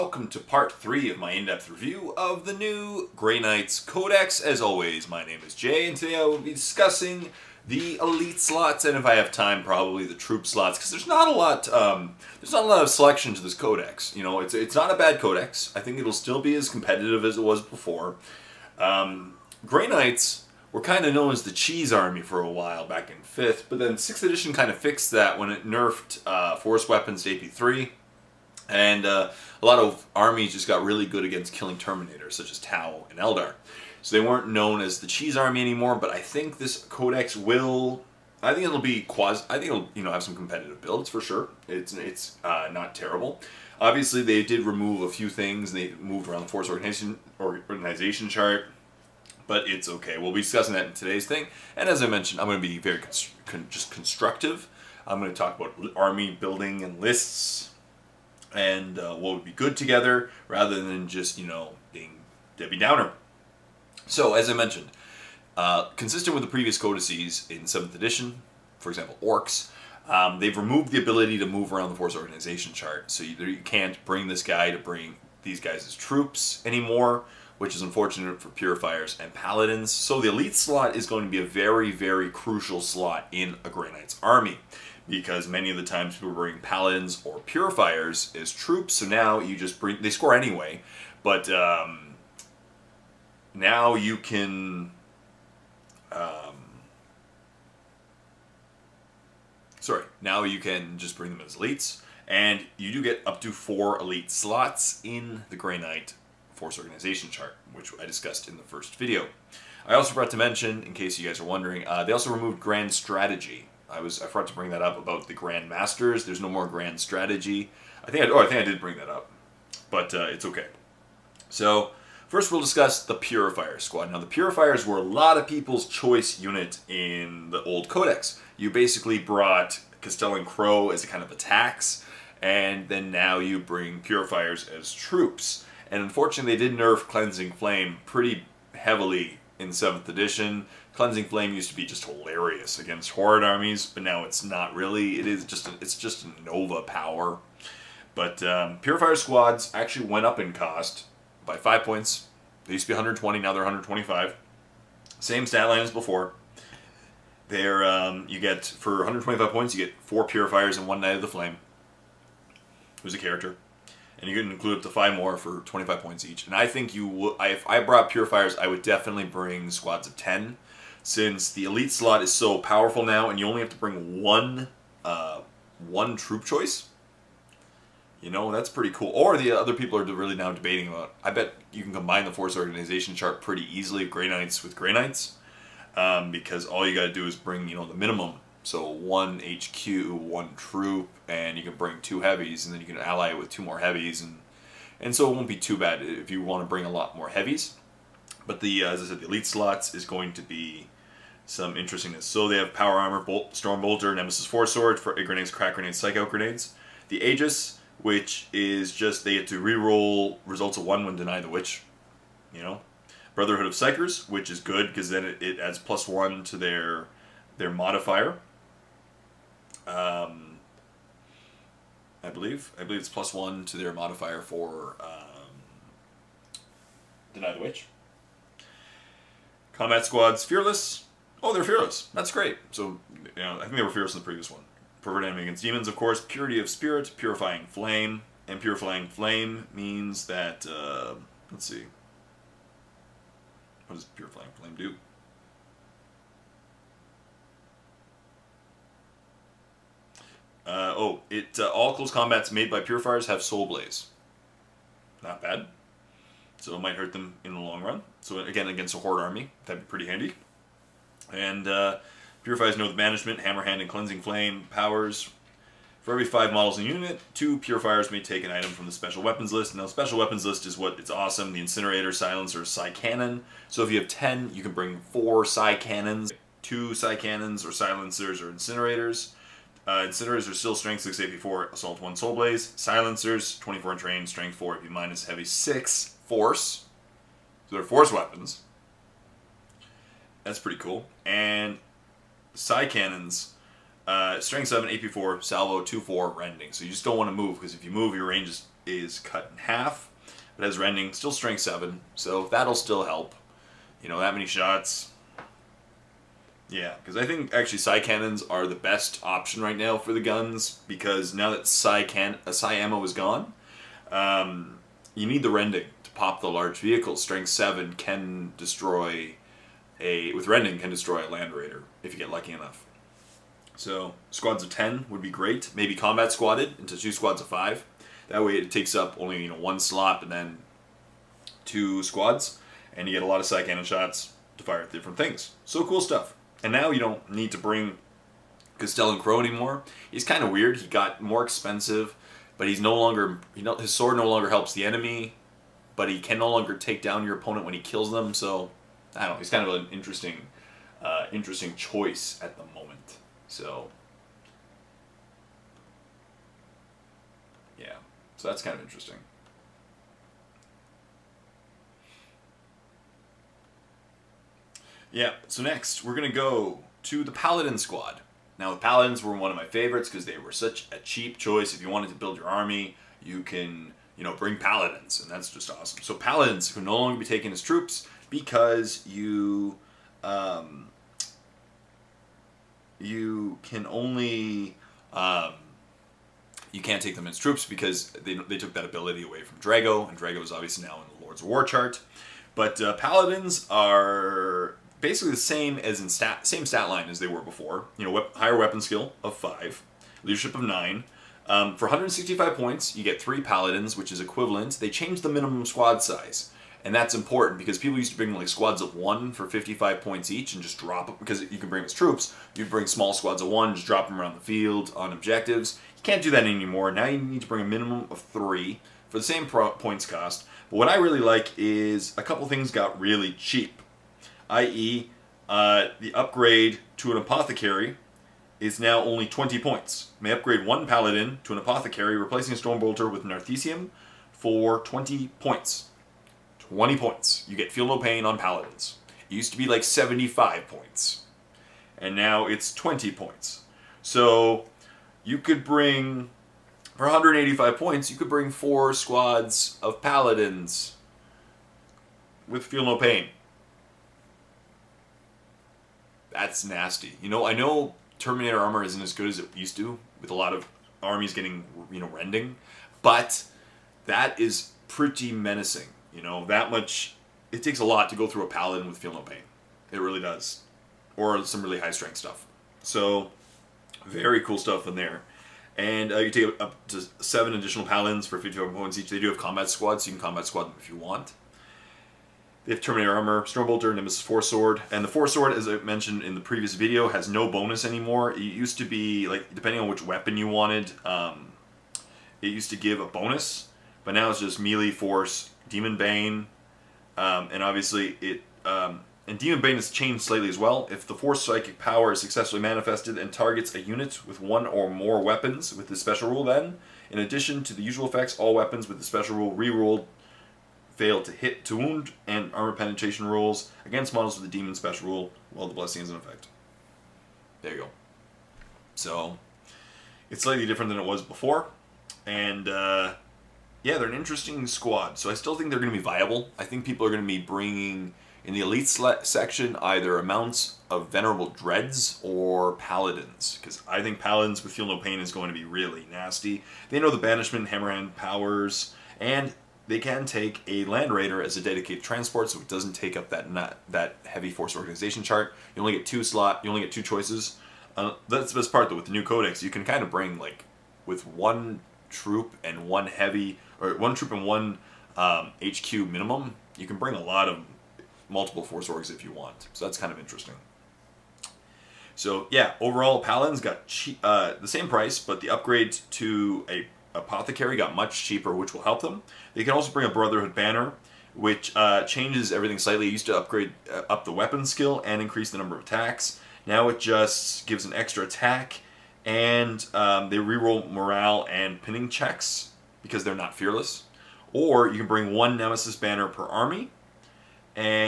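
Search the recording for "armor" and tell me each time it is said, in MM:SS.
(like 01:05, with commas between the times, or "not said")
03:22, 07:38, 08:03, 08:32.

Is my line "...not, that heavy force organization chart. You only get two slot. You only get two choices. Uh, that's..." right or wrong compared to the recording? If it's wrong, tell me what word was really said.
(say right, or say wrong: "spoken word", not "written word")
right.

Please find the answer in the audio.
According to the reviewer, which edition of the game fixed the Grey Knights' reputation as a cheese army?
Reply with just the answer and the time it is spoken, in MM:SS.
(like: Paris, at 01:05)
6th edition, at 00:23.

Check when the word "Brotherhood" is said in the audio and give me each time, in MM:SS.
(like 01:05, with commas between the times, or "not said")
03:33, 09:30.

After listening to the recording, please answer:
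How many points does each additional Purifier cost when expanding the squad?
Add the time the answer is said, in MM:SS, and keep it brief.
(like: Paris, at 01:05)
25 points, at 02:45.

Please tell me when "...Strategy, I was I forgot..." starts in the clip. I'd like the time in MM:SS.
01:52.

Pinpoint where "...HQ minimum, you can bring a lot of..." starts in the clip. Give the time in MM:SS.
09:15.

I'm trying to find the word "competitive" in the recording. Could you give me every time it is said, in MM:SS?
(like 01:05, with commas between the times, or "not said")
00:16, 00:40.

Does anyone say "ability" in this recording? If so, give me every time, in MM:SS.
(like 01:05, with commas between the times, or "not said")
01:10, 06:28.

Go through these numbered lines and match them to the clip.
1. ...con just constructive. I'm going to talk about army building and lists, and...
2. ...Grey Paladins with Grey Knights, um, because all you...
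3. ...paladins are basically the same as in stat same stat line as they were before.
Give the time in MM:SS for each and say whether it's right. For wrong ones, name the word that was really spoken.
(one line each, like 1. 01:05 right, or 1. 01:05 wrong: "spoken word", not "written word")
1. 00:53 right
2. 03:04 wrong: "Knights", not "Paladins"
3. 06:32 right.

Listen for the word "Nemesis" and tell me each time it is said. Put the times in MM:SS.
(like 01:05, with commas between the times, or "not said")
03:24, 08:03, 09:45.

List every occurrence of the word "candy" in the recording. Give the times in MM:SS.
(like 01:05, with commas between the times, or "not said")
not said.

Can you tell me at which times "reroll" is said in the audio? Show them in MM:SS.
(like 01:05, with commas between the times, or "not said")
03:29, 09:40.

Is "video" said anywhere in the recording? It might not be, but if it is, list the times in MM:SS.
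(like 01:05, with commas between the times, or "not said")
01:48, 08:06.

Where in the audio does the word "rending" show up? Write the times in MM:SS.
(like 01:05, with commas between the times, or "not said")
04:56, 05:00, 05:15, 05:20, 07:42.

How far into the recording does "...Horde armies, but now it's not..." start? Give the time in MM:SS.
02:23.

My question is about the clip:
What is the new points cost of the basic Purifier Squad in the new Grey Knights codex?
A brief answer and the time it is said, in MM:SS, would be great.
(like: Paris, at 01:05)
125, at 02:33.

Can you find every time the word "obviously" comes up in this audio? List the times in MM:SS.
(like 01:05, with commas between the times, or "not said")
00:43, 06:30, 08:17.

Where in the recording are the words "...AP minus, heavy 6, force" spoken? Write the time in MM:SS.
04:44.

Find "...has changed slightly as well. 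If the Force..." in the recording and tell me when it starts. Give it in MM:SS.
08:19.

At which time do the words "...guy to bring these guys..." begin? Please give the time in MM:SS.
01:14.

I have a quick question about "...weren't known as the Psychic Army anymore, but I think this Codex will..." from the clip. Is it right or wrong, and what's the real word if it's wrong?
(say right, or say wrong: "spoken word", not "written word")
wrong: "Cheese", not "Psychic".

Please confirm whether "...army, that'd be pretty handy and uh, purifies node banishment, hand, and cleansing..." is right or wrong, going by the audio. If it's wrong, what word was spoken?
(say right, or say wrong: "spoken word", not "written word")
right.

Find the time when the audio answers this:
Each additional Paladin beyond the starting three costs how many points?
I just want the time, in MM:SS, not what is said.
07:58.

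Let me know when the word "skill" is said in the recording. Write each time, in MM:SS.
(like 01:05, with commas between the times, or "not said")
06:38, 09:34.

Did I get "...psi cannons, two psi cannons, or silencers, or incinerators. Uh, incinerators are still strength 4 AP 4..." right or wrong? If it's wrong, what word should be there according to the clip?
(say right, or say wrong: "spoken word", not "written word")
wrong: "6", not "4".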